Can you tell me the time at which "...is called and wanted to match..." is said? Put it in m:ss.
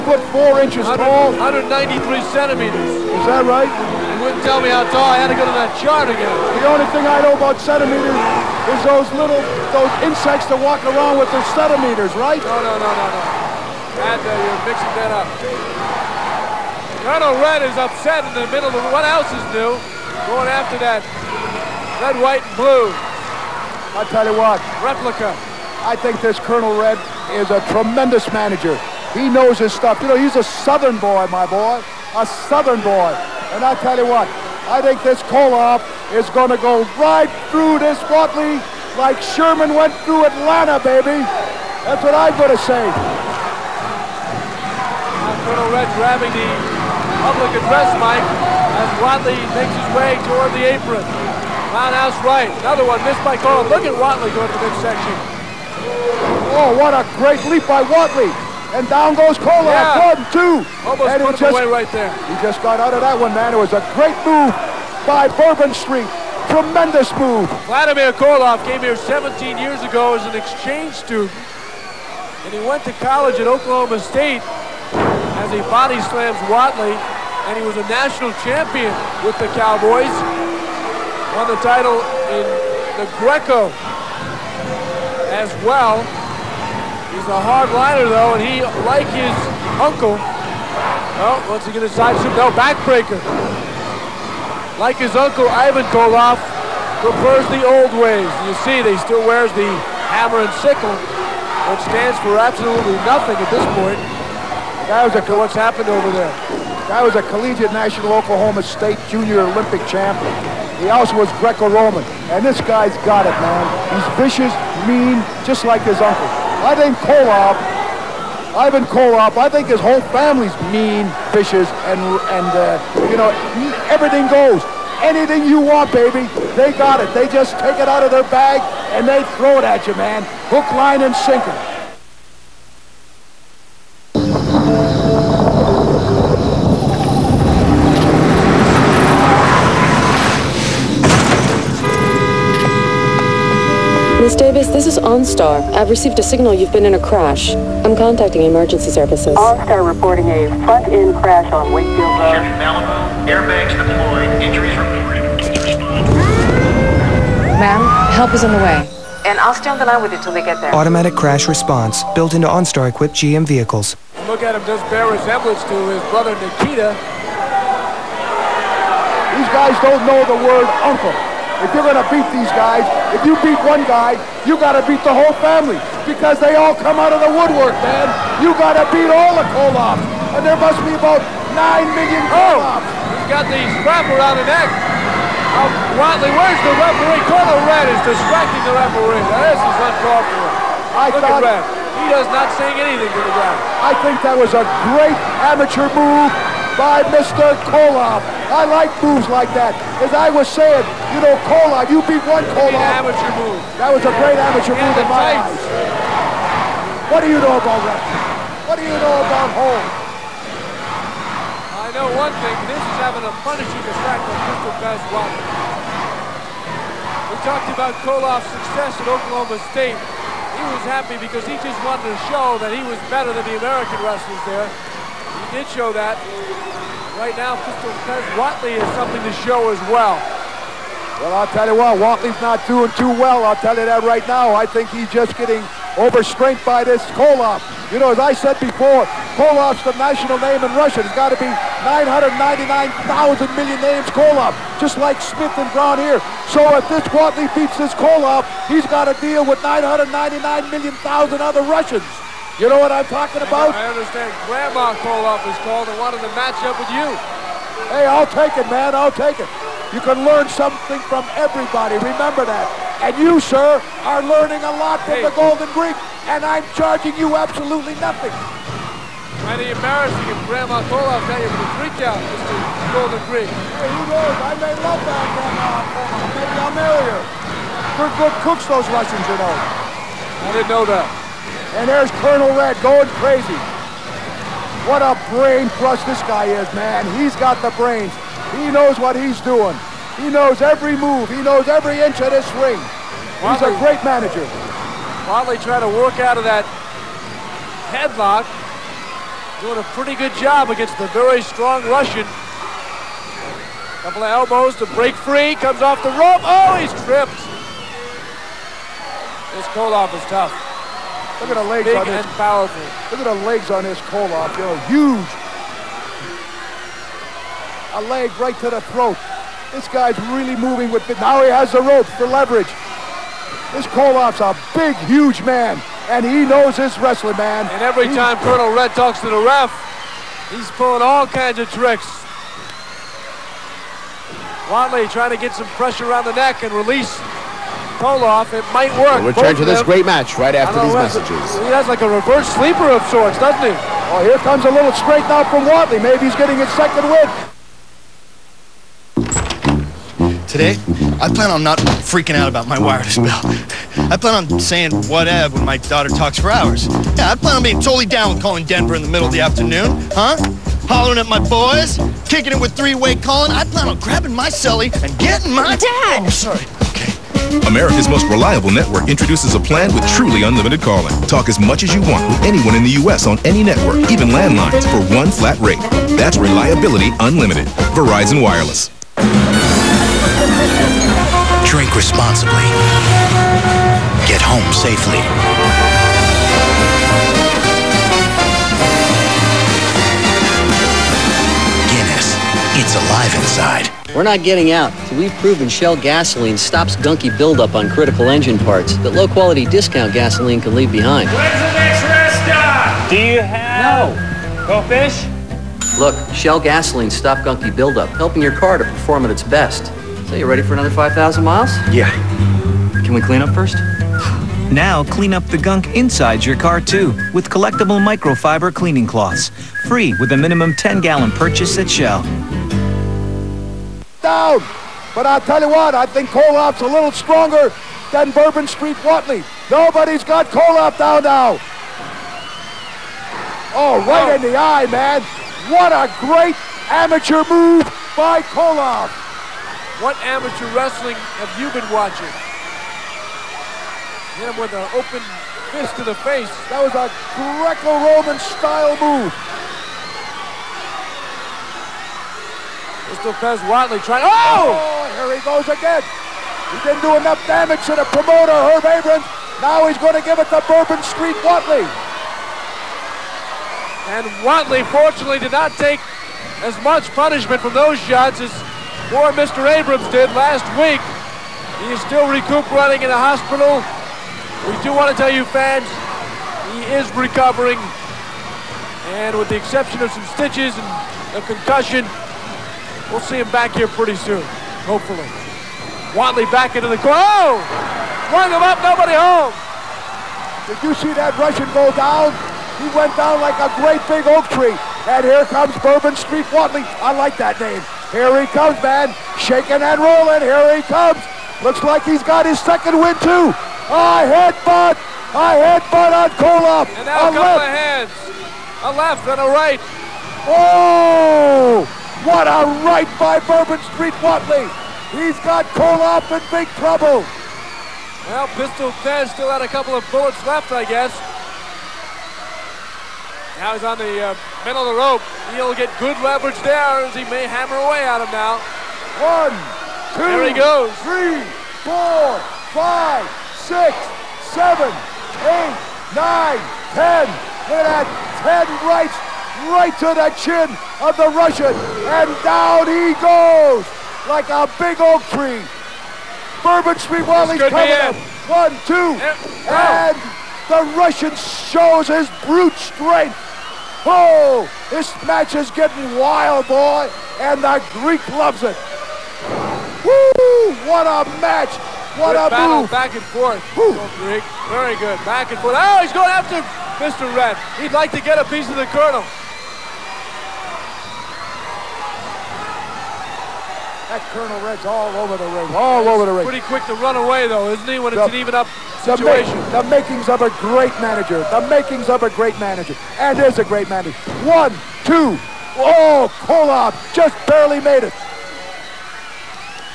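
4:15.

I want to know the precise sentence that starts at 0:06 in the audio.
The only thing I know about centimeters is those little, those insects that walk around with their centimeters, right?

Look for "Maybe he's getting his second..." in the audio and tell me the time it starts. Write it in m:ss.
5:45.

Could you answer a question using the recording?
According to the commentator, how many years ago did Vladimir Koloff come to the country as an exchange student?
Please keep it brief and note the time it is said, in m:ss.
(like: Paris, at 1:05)
17, at 1:08.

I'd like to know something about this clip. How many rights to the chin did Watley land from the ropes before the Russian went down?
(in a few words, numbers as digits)
10.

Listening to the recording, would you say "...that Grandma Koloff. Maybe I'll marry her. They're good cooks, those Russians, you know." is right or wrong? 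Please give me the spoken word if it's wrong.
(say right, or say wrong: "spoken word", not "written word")
right.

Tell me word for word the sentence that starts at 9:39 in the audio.
The, the makings of a great manager.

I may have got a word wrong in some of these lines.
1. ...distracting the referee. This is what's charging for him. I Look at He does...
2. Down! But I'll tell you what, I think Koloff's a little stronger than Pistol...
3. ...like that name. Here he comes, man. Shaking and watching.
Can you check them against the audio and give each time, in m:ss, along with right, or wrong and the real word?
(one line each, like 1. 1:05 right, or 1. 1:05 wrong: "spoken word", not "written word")
1. 3:08 wrong: "wrong", not "charging"
2. 7:04 wrong: "Bourbon", not "Pistol"
3. 8:17 wrong: "rolling", not "watching".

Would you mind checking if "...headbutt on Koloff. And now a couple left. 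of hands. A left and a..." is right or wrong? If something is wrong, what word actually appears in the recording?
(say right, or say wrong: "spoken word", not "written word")
right.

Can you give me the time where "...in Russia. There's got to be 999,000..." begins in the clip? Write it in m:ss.
4:00.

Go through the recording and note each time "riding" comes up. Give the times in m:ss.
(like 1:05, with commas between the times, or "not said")
not said.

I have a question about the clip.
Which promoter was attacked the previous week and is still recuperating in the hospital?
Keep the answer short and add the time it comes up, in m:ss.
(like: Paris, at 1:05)
Herb Abrams, at 7:38.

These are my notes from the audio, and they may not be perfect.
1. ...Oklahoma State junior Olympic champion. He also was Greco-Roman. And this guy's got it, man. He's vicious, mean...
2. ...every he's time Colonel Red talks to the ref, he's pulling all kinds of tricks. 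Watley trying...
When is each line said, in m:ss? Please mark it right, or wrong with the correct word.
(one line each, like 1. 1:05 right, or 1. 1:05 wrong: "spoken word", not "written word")
1. 1:48 right
2. 5:27 right.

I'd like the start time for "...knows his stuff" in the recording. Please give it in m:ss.
0:29.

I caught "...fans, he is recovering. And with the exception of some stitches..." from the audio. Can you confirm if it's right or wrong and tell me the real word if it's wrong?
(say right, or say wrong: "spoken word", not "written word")
right.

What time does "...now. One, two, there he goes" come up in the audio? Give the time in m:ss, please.
8:48.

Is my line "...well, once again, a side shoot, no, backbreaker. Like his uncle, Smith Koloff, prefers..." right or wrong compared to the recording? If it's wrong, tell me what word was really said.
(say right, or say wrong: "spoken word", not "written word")
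wrong: "Ivan", not "Smith".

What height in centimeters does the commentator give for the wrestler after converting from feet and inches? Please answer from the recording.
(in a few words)
193.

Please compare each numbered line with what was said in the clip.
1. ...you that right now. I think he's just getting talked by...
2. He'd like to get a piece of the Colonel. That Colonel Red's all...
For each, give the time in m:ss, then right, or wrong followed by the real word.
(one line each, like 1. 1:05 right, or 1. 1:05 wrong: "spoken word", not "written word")
1. 3:53 wrong: "overstrained", not "talked"
2. 9:27 right.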